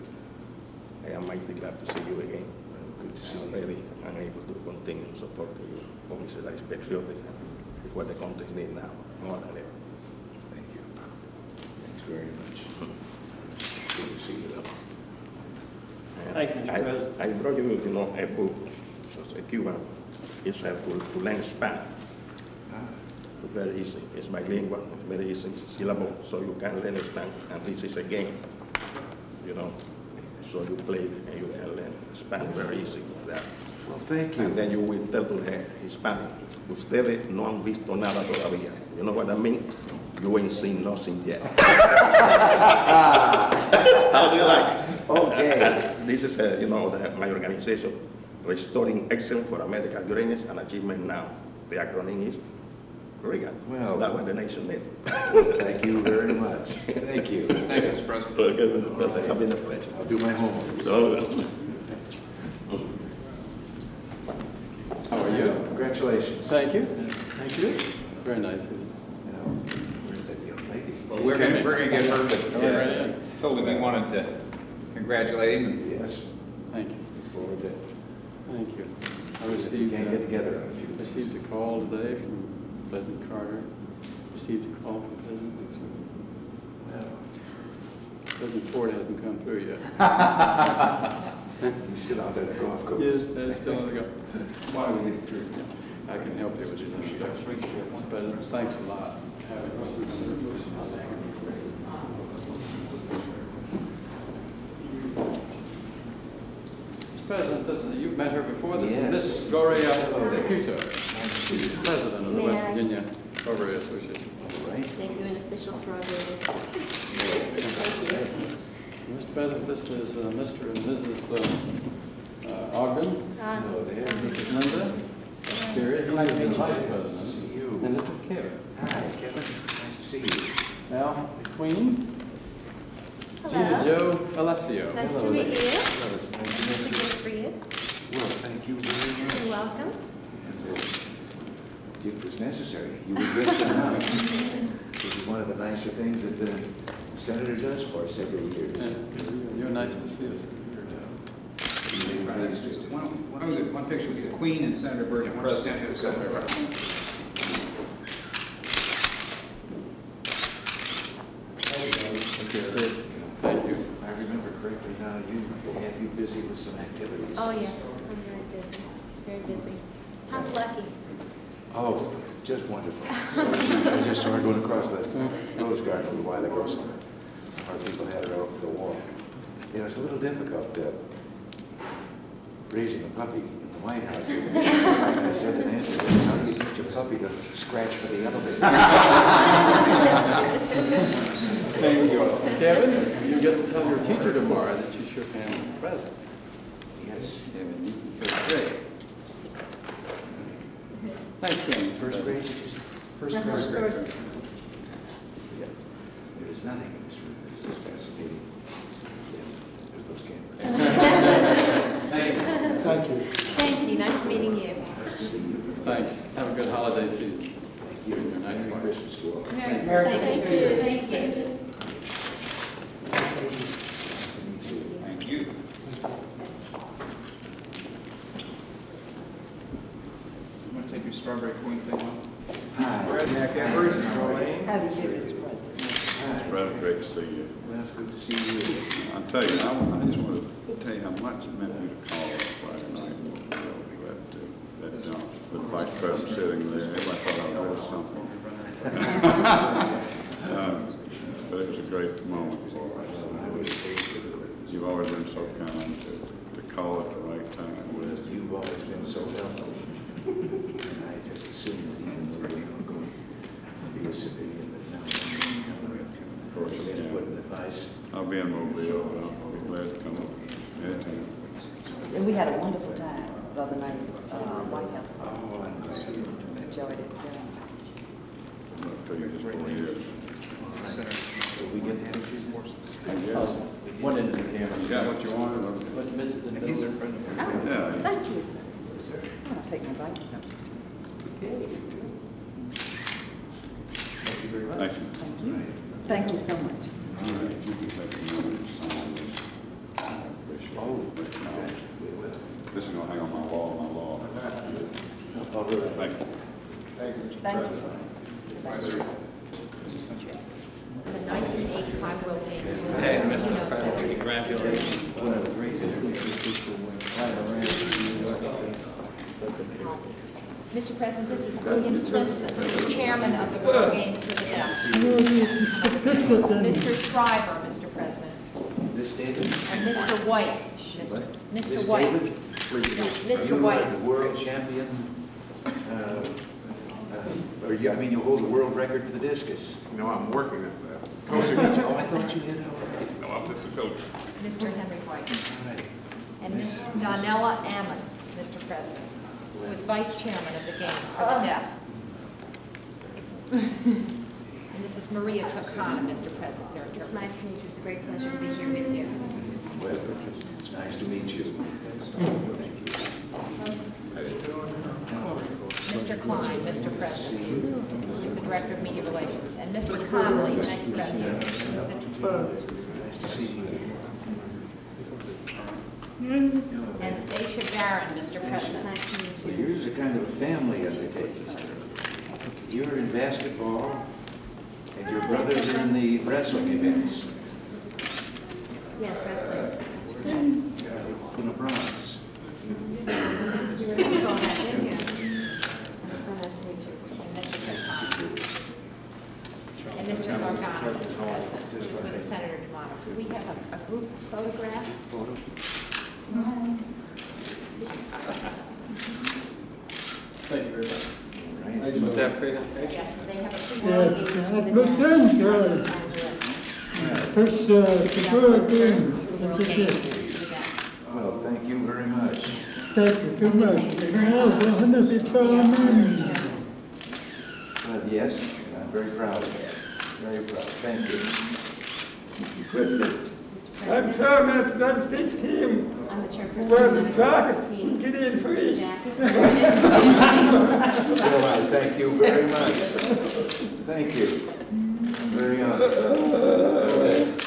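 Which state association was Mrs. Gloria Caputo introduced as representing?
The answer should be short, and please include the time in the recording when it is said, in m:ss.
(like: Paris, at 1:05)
Virginia Strawberry Association, at 1:52.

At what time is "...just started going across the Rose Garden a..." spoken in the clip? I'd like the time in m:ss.
2:54.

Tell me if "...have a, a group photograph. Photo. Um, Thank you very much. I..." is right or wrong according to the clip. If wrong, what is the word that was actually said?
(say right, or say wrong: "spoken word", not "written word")
right.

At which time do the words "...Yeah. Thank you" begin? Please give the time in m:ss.
4:47.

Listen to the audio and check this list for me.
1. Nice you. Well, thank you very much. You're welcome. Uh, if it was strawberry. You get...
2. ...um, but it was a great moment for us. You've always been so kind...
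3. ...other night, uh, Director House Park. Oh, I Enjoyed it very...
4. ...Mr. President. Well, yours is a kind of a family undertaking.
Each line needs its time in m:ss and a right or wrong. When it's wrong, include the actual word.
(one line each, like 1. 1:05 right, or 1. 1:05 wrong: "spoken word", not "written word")
1. 2:17 wrong: "necessary", not "strawberry"
2. 4:10 right
3. 4:33 wrong: "White", not "Director"
4. 6:18 right.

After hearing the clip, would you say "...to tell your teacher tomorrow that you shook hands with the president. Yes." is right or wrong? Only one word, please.
right.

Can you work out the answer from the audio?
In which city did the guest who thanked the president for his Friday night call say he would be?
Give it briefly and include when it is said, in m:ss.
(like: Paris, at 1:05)
Mobile, at 4:28.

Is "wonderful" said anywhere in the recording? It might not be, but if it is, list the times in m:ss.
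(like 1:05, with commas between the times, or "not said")
2:52, 4:32.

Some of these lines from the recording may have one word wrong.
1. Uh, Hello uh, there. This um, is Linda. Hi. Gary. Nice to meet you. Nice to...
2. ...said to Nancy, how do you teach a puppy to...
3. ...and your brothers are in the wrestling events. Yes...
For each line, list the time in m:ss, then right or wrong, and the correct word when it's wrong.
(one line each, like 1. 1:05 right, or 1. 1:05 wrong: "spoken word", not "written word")
1. 2:03 right
2. 3:05 right
3. 6:24 right.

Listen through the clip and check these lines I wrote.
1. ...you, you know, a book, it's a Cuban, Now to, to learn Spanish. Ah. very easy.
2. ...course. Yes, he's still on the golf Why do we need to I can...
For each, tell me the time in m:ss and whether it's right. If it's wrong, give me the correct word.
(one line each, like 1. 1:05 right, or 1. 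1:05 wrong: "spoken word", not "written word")
1. 0:17 wrong: "Israel", not "Now"
2. 1:32 right.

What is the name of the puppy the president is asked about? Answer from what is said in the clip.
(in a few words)
Lucky.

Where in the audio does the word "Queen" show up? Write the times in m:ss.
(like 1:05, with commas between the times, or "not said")
2:11, 2:34.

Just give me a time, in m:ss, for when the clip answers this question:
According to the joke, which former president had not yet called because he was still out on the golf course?
1:28.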